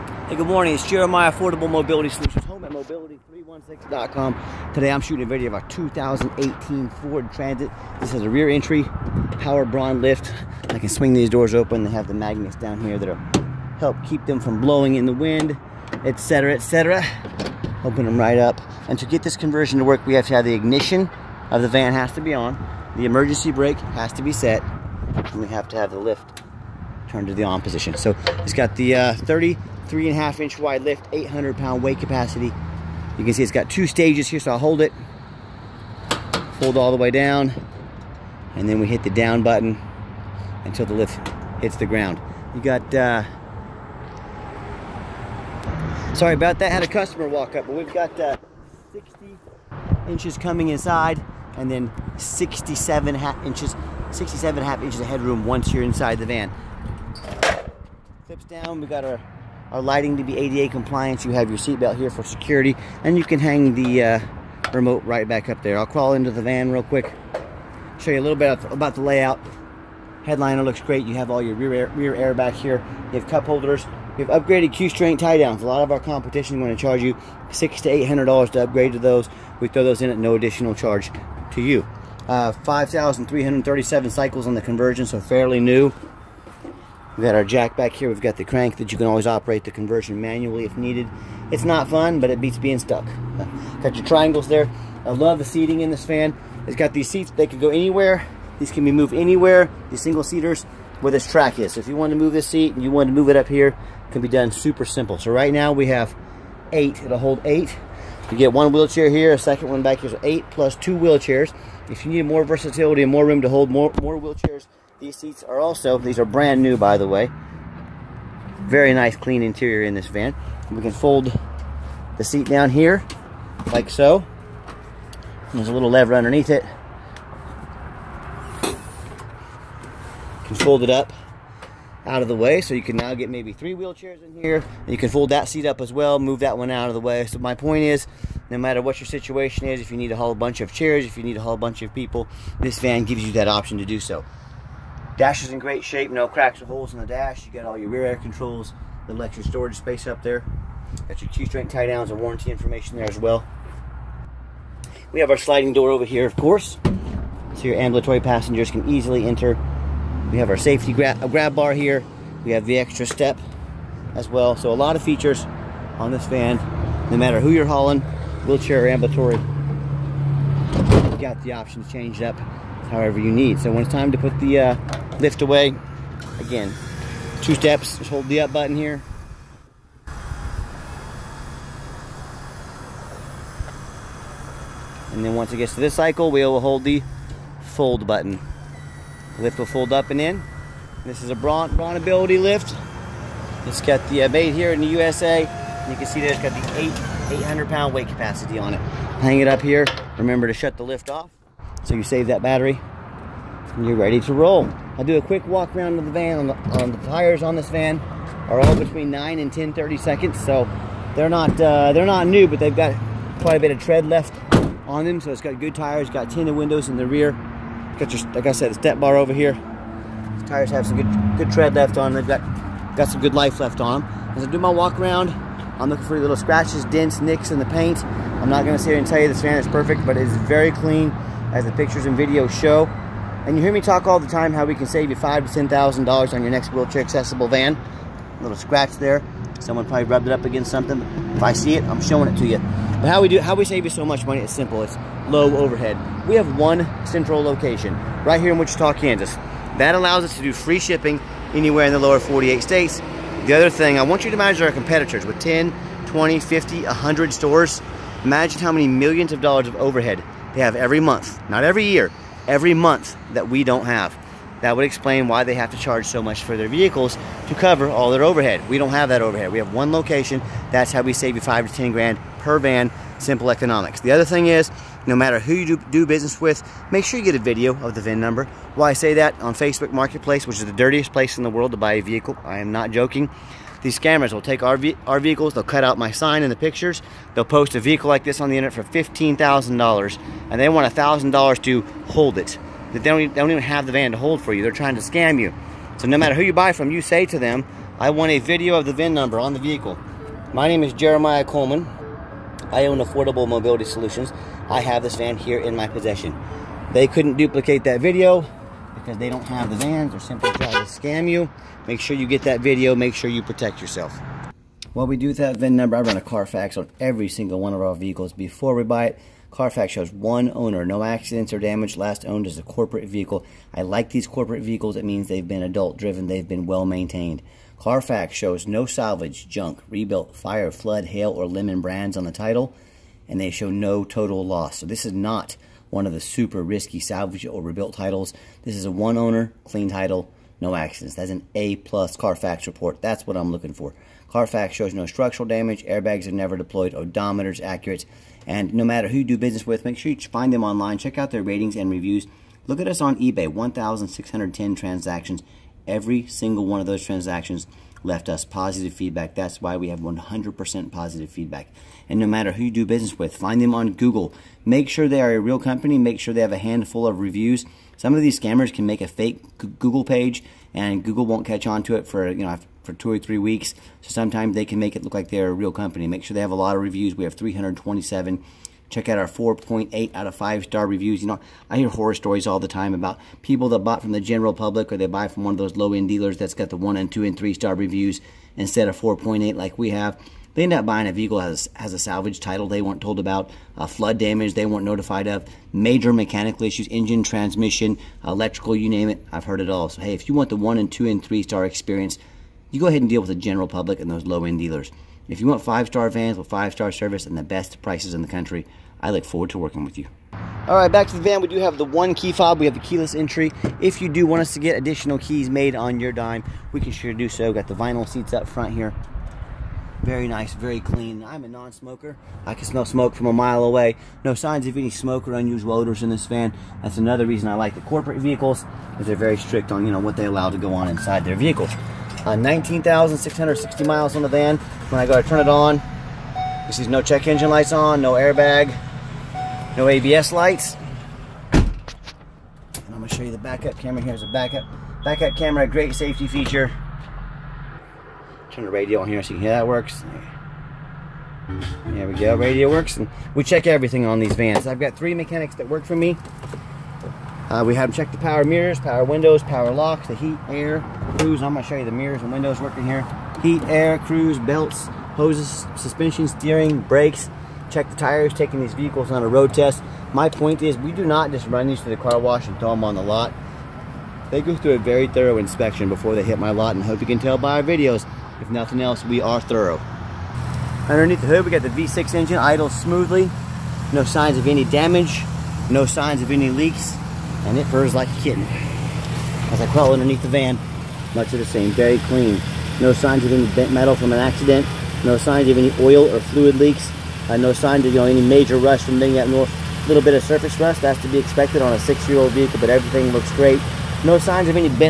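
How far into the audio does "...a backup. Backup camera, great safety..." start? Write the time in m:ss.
7:24.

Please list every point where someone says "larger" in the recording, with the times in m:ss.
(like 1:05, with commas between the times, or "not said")
not said.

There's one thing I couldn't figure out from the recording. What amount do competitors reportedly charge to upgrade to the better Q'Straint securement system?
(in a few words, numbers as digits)
600 to 800 dollars.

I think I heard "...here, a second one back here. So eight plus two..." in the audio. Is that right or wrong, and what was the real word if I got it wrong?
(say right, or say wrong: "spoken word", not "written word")
right.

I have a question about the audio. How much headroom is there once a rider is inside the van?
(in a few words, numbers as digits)
67.5 inches.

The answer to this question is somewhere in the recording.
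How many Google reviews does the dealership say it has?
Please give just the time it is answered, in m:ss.
6:17.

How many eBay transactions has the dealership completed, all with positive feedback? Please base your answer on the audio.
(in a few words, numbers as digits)
1,610.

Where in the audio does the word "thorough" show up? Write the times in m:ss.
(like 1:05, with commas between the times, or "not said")
7:55, 7:59.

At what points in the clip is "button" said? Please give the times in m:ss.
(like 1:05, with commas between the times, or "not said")
0:39, 2:58, 3:08.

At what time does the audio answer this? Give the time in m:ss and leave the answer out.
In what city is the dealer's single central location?
4:08.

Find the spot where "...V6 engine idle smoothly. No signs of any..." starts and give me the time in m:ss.
8:01.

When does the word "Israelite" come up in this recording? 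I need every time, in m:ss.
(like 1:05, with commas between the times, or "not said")
not said.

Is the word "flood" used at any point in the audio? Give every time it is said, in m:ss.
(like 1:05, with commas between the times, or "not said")
5:30, 6:33.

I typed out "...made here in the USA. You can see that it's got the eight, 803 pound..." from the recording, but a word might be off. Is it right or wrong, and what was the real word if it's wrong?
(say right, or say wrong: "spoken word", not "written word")
wrong: "800", not "803".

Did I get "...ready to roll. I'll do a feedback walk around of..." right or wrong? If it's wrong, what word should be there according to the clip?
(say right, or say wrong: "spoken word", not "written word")
wrong: "quick", not "feedback".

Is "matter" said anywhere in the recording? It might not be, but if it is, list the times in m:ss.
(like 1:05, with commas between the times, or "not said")
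2:18, 2:47, 4:35, 4:56, 5:48, 6:02.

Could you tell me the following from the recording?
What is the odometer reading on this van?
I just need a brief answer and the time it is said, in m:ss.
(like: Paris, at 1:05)
19,660 miles, at 7:12.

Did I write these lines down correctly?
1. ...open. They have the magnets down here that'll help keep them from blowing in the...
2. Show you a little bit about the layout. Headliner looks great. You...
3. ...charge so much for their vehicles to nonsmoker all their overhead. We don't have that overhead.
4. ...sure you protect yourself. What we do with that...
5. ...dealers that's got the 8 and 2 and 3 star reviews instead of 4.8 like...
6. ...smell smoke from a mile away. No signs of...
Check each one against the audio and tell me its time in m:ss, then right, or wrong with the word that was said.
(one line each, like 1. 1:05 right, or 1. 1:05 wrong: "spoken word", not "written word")
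1. 0:11 right
2. 1:07 right
3. 4:25 wrong: "cover", not "nonsmoker"
4. 5:13 right
5. 6:26 wrong: "1", not "8"
6. 7:02 right.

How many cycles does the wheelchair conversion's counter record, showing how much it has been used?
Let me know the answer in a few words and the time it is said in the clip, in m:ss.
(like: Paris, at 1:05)
5,337, at 1:22.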